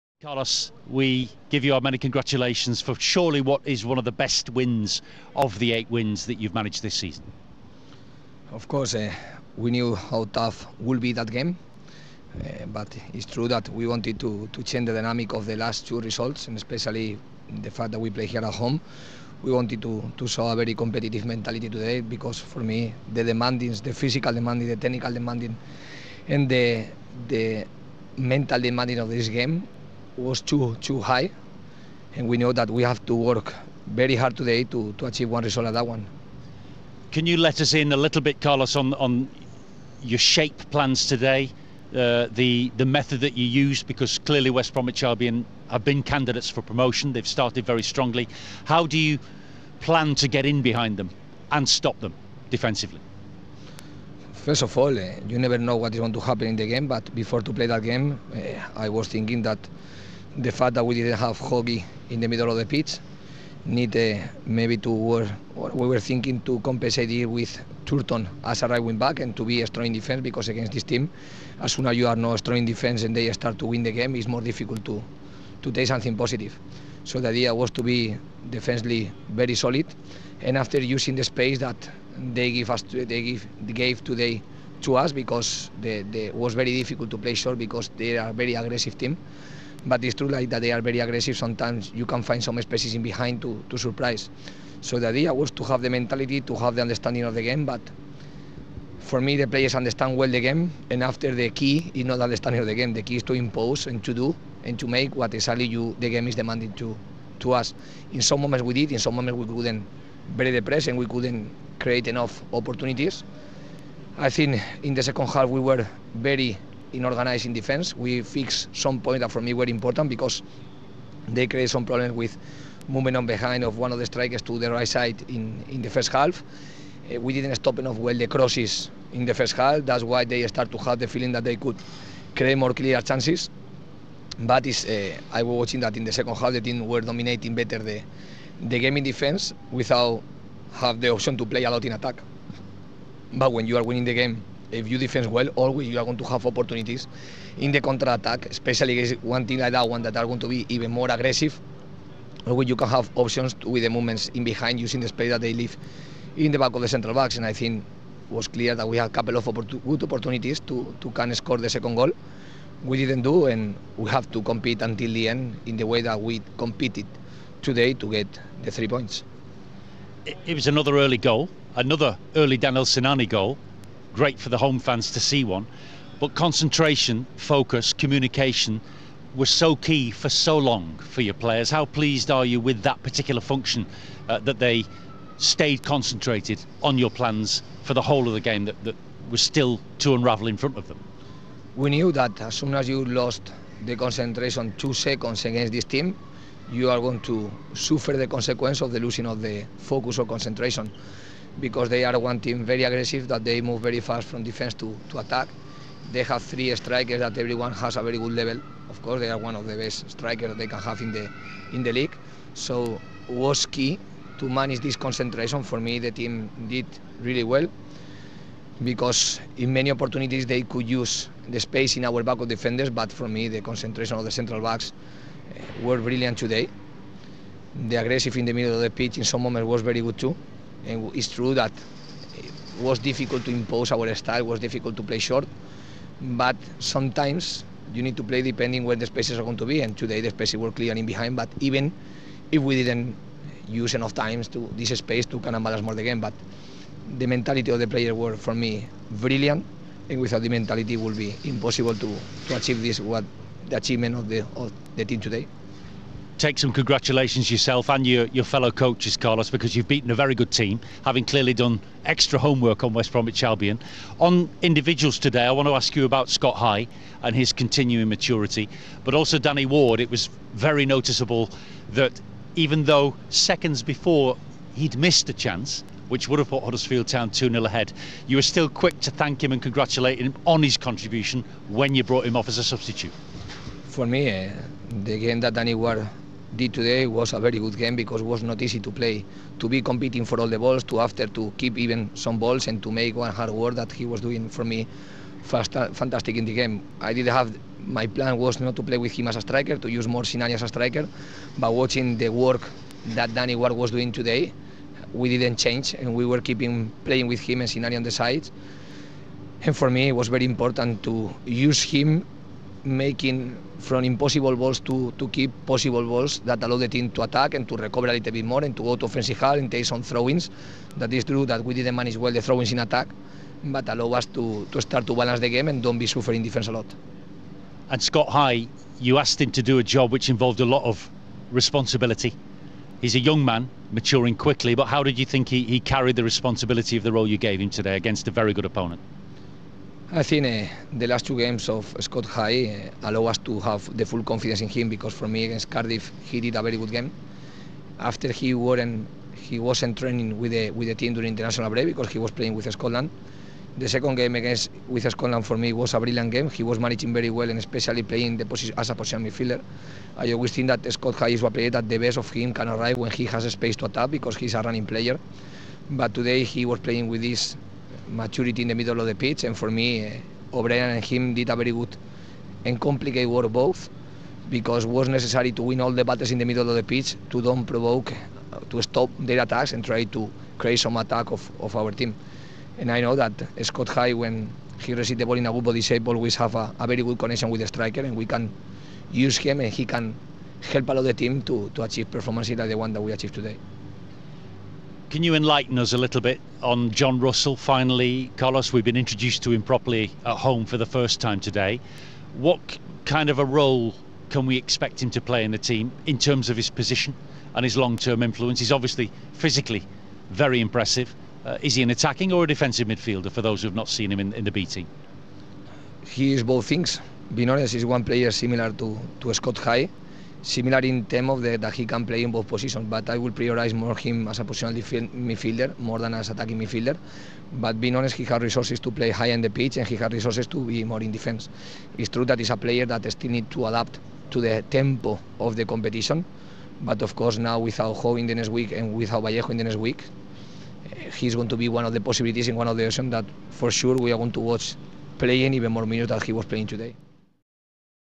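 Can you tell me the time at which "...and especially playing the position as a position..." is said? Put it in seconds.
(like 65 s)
357 s.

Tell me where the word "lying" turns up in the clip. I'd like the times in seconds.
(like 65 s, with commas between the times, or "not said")
not said.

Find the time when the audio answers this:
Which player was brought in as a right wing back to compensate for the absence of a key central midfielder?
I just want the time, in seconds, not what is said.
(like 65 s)
67 s.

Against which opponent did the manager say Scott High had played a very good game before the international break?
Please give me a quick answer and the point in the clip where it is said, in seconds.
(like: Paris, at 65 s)
Cardiff, at 345 s.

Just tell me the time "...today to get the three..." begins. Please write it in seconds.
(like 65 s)
167 s.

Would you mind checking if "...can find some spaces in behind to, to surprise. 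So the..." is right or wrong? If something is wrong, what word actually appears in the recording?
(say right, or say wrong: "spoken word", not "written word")
right.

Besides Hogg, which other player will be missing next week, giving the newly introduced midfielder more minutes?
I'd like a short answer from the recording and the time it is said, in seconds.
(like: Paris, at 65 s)
Vallejo, at 439 s.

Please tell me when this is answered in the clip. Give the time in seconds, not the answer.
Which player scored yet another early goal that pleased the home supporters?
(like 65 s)
172 s.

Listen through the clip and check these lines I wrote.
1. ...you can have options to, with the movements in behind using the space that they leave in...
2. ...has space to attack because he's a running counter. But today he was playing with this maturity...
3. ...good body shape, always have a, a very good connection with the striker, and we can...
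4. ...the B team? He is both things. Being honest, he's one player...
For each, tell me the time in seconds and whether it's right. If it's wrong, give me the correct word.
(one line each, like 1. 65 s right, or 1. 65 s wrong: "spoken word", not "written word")
1. 152 s right
2. 363 s wrong: "player", not "counter"
3. 385 s right
4. 414 s right.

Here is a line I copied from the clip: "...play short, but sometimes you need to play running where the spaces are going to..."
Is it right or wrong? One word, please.
wrong.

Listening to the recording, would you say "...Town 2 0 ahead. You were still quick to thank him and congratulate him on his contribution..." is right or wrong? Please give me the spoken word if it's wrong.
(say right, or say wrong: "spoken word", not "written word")
right.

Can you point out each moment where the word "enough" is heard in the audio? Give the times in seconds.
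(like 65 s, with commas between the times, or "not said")
112 s, 127 s, 243 s.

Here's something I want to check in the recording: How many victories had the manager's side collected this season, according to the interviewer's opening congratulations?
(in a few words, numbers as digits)
8.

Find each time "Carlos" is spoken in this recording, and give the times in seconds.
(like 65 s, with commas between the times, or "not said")
0 s, 38 s, 259 s, 398 s.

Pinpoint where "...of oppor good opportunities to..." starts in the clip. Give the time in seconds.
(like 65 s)
159 s.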